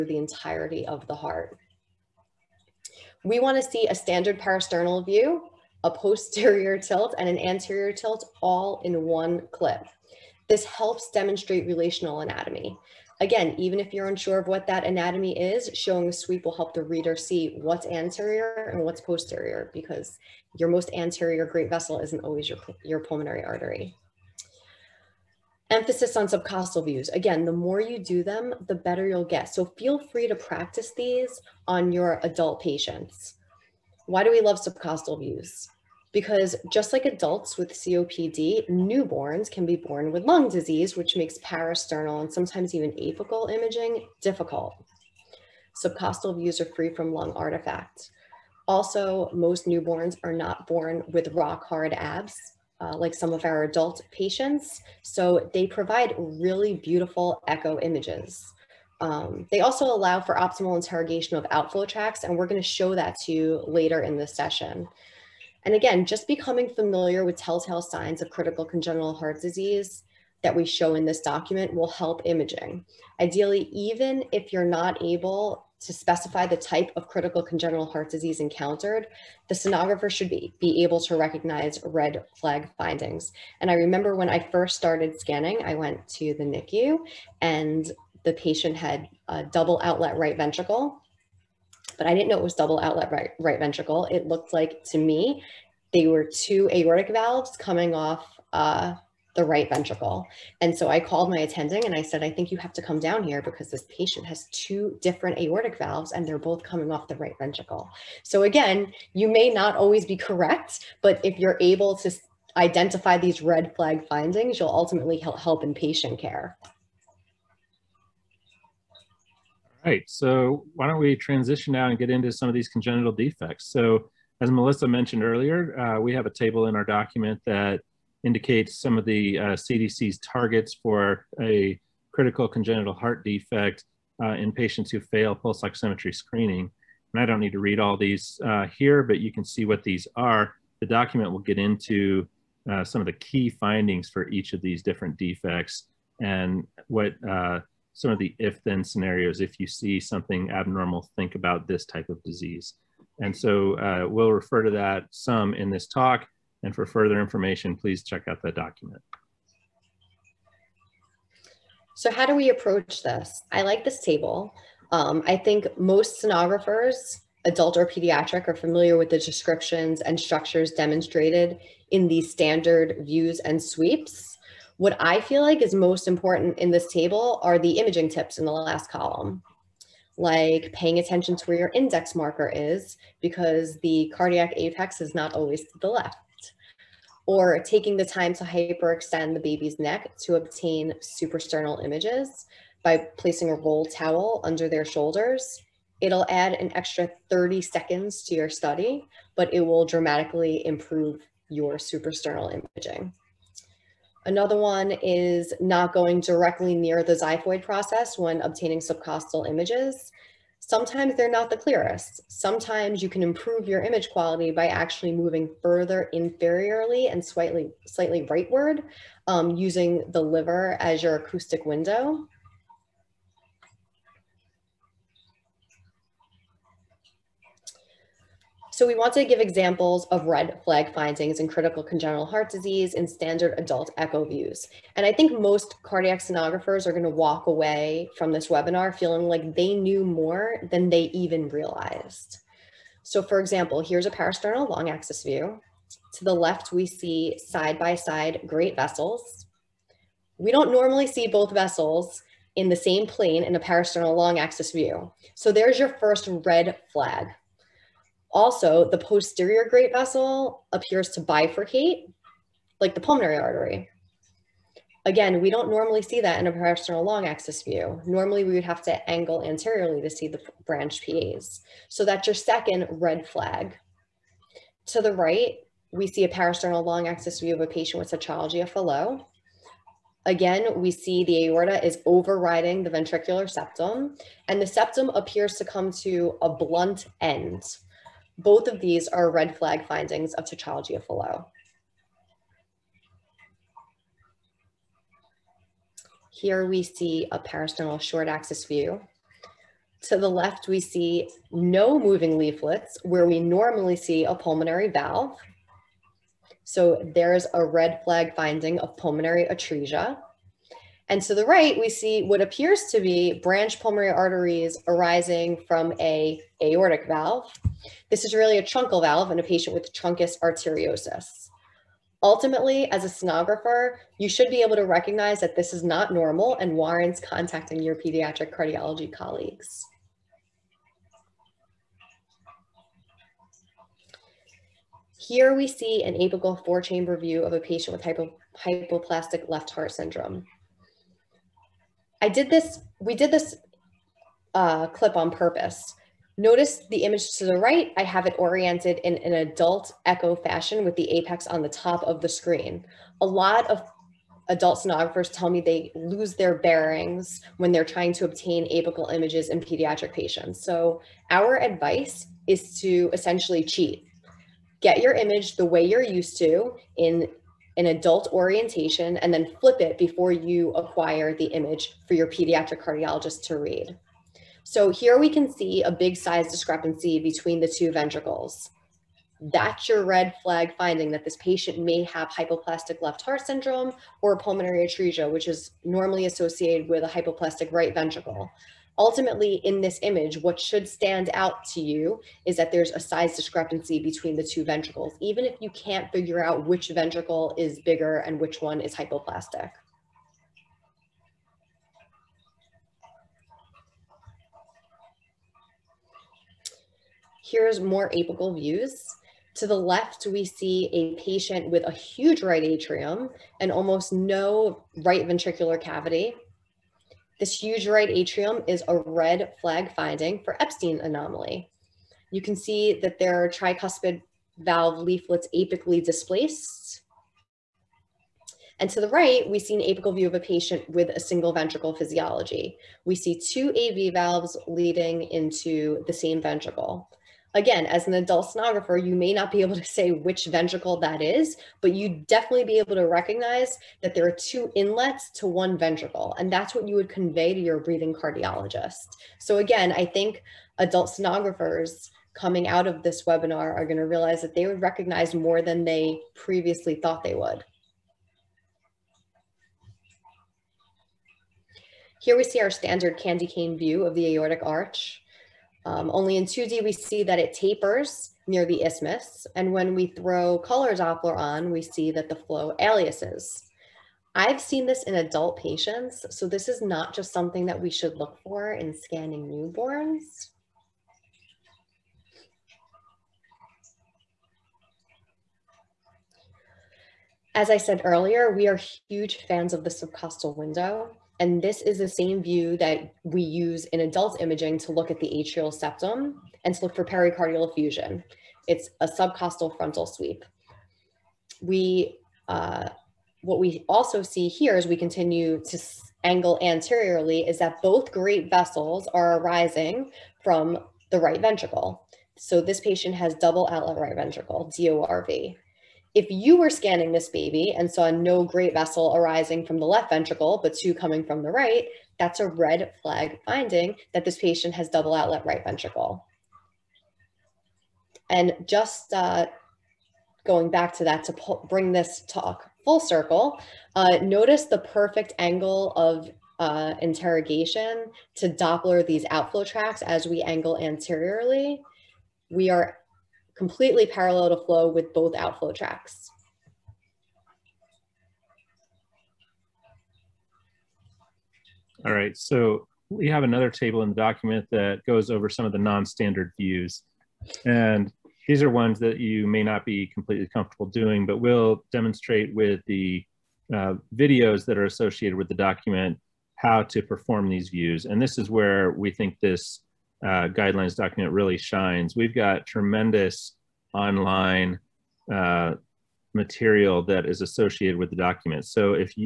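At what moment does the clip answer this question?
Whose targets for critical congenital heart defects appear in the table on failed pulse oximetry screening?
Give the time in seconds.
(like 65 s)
129 s.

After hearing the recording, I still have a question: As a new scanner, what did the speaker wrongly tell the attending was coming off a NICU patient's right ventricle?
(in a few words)
Two aortic valves.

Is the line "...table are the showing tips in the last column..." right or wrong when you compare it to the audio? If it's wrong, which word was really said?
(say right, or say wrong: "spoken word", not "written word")
wrong: "imaging", not "showing".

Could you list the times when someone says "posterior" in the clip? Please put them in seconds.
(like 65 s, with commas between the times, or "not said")
5 s, 18 s, 258 s.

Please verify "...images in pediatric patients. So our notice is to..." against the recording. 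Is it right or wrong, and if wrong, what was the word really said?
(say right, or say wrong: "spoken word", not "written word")
wrong: "advice", not "notice".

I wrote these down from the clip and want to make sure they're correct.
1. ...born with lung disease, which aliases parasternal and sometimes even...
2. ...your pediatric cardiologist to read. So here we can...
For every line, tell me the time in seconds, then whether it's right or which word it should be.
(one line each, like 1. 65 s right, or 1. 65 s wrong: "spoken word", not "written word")
1. 39 s wrong: "makes", not "aliases"
2. 372 s right.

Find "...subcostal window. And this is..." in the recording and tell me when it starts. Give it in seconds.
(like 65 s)
489 s.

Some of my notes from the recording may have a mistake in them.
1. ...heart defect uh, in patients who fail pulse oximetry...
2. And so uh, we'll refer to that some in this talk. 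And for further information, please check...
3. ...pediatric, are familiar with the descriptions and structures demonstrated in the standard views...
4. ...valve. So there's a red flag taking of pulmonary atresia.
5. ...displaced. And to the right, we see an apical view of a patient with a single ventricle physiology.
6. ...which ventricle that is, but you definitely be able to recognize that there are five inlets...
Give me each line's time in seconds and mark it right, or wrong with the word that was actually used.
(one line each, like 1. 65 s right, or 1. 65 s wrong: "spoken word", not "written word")
1. 132 s right
2. 153 s right
3. 167 s right
4. 304 s wrong: "finding", not "taking"
5. 426 s right
6. 440 s wrong: "two", not "five".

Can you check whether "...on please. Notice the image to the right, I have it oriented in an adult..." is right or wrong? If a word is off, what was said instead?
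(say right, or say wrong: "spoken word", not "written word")
wrong: "purpose", not "please".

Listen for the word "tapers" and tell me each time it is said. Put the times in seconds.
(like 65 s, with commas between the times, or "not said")
467 s.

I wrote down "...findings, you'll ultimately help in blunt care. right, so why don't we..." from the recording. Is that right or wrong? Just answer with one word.
wrong.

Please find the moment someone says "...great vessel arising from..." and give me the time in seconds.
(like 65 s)
518 s.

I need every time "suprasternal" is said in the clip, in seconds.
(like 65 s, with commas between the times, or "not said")
190 s, 201 s.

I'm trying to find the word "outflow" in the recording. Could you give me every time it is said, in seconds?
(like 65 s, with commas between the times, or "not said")
61 s, 539 s, 545 s.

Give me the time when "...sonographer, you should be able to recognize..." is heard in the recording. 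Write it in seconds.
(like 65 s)
323 s.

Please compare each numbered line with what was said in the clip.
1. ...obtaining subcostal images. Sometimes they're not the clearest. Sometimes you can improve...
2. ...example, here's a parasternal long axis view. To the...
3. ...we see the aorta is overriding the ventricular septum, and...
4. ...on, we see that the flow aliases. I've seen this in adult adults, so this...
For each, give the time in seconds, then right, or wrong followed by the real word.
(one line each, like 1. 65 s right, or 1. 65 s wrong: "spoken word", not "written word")
1. 208 s right
2. 243 s right
3. 280 s right
4. 471 s wrong: "patients", not "adults".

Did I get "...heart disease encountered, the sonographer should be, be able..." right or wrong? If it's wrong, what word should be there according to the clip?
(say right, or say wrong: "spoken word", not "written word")
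right.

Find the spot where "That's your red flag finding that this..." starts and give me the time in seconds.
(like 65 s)
379 s.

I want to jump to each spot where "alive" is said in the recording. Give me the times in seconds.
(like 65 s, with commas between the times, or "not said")
not said.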